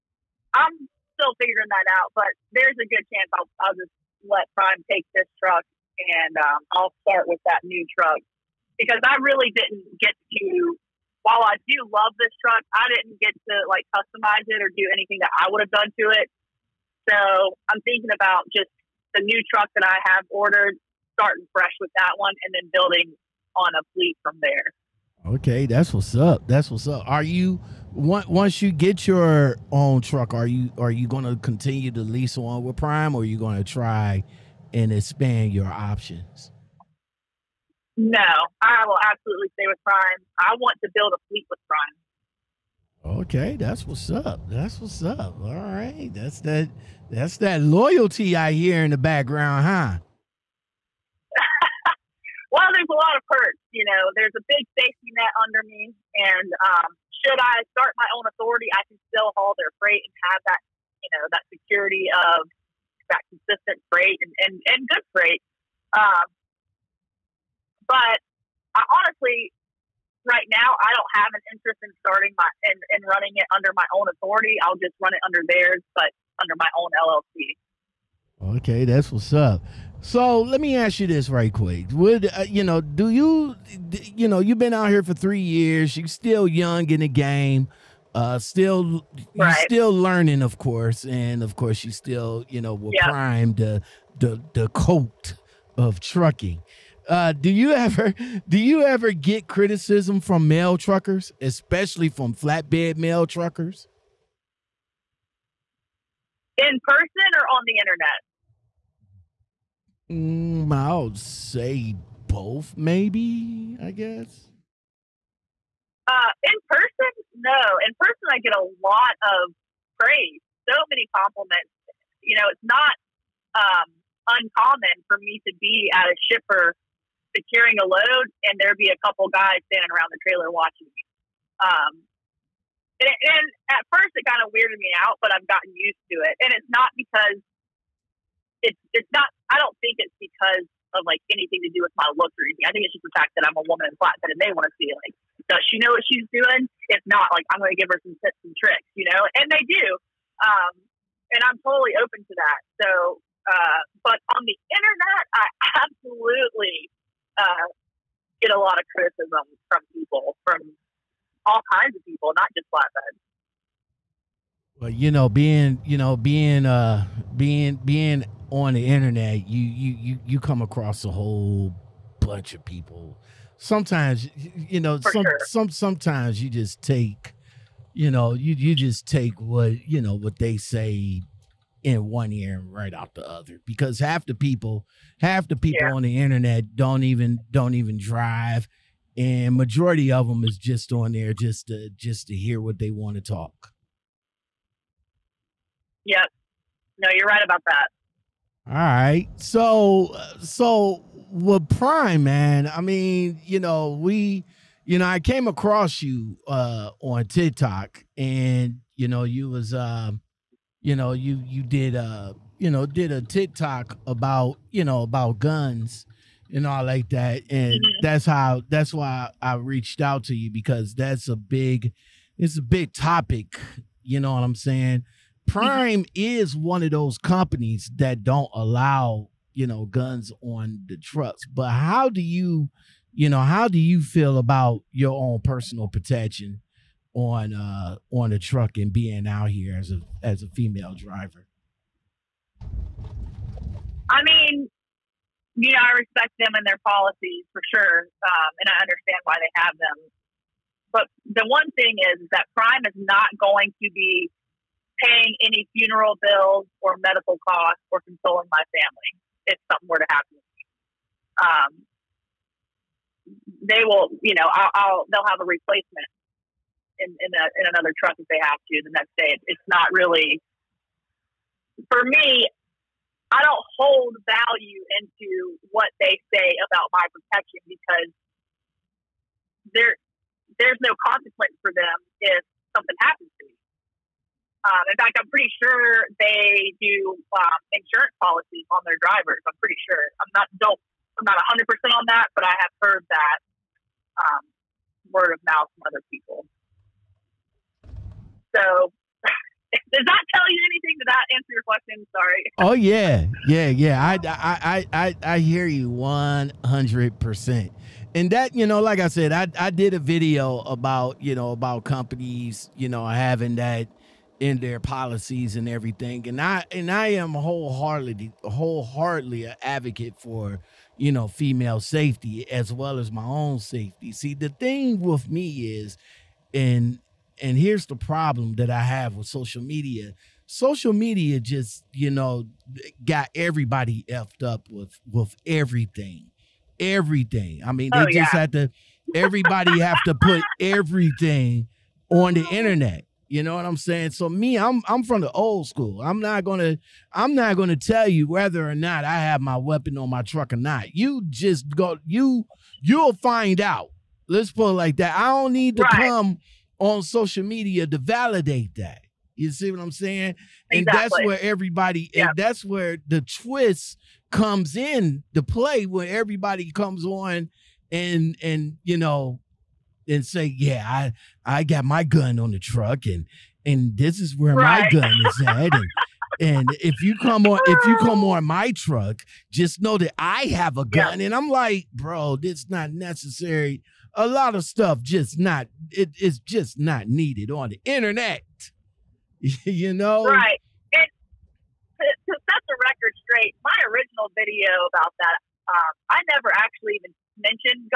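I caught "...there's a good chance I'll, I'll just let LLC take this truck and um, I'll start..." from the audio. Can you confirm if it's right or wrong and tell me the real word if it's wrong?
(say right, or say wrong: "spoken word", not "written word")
wrong: "Prime", not "LLC".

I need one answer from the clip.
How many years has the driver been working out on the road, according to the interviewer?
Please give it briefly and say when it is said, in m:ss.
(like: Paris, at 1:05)
3, at 1:25.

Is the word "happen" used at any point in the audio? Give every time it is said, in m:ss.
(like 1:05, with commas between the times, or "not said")
4:20, 4:43.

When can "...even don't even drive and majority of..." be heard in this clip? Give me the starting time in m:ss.
3:07.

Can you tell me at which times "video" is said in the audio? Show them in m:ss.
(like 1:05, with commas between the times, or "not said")
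5:09, 6:34.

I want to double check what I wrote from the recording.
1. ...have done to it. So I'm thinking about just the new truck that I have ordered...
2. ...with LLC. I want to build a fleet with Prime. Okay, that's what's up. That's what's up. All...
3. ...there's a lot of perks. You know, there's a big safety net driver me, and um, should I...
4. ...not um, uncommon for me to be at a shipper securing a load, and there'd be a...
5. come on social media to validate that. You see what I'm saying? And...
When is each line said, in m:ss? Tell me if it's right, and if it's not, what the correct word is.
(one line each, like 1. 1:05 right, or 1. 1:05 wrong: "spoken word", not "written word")
1. 0:15 right
2. 0:39 wrong: "Prime", not "LLC"
3. 0:52 wrong: "under", not "driver"
4. 2:02 right
5. 5:56 right.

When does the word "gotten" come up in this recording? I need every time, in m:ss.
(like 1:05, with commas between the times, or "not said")
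2:15.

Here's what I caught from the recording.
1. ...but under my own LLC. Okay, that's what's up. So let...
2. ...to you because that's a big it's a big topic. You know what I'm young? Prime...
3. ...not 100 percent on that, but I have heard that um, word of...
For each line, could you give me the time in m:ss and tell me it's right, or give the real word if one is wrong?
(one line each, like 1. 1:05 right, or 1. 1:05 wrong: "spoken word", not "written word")
1. 1:15 right
2. 3:40 wrong: "saying", not "young"
3. 4:51 right.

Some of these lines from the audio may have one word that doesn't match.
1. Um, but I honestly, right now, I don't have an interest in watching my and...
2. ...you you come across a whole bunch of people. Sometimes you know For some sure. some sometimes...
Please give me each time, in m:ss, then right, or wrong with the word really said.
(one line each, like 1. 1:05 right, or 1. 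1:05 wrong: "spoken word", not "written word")
1. 1:05 wrong: "starting", not "watching"
2. 2:49 right.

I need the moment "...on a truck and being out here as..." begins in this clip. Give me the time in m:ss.
3:58.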